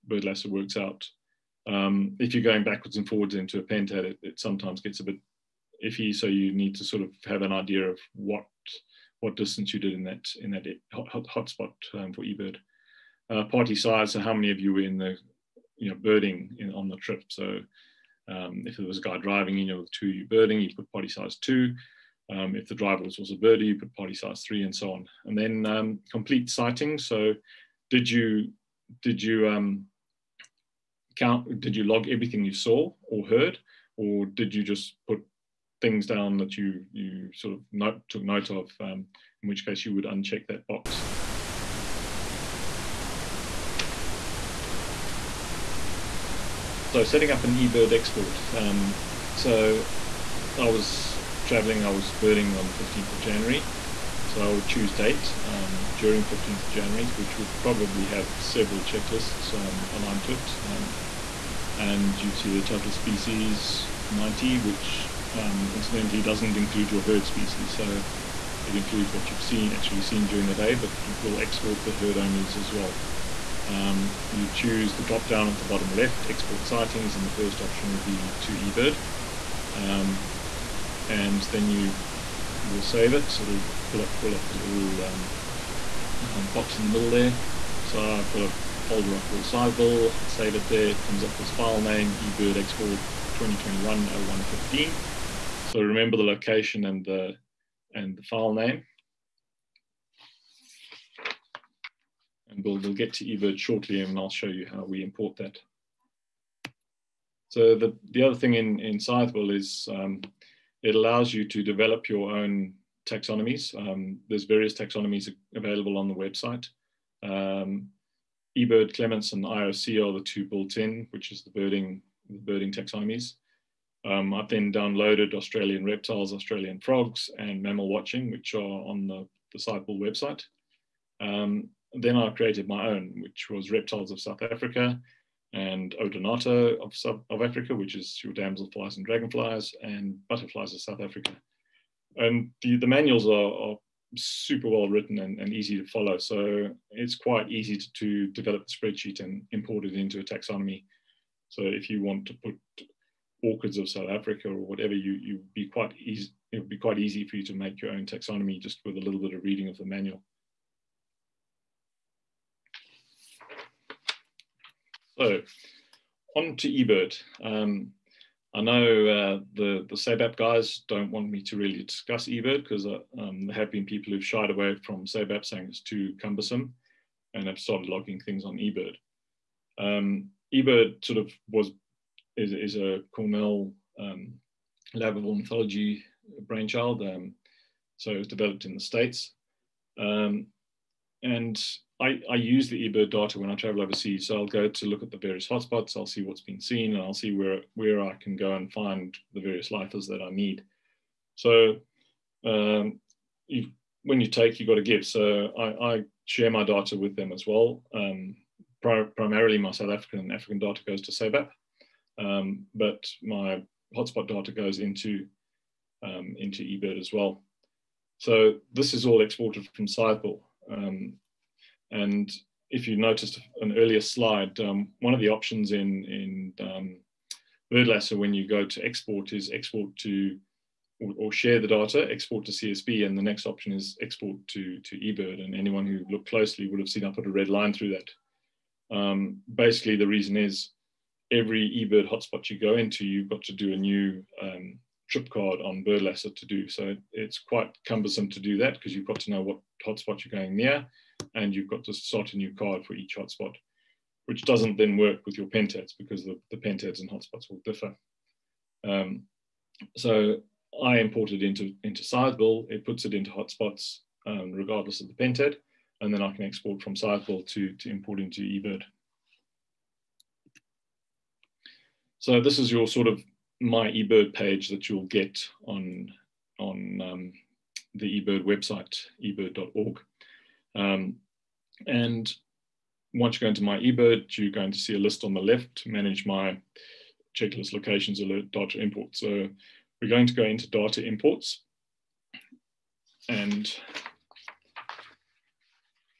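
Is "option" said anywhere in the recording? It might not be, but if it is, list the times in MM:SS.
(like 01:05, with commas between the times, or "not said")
01:17, 03:45, 03:53.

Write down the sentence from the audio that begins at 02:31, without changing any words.
So if you want to put orchids of South Africa or whatever, you you be quite easy.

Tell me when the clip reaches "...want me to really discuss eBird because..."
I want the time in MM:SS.
02:51.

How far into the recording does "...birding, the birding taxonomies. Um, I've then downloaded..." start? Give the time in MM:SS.
02:01.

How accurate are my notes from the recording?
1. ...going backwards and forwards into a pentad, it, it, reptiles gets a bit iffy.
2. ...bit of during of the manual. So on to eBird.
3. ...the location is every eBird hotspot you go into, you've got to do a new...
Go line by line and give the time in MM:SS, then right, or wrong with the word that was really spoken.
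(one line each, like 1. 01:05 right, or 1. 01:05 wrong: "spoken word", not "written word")
1. 00:02 wrong: "sometimes", not "reptiles"
2. 02:39 wrong: "reading", not "during"
3. 03:59 wrong: "reason", not "location".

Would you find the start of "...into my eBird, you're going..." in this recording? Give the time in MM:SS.
04:43.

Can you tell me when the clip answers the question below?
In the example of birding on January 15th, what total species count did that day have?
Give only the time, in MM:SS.
01:04.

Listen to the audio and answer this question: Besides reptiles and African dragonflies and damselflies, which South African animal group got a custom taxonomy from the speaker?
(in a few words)
Butterflies.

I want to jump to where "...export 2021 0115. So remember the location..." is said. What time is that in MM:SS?
01:32.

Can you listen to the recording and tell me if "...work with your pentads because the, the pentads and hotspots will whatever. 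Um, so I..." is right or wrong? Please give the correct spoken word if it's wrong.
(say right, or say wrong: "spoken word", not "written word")
wrong: "differ", not "whatever".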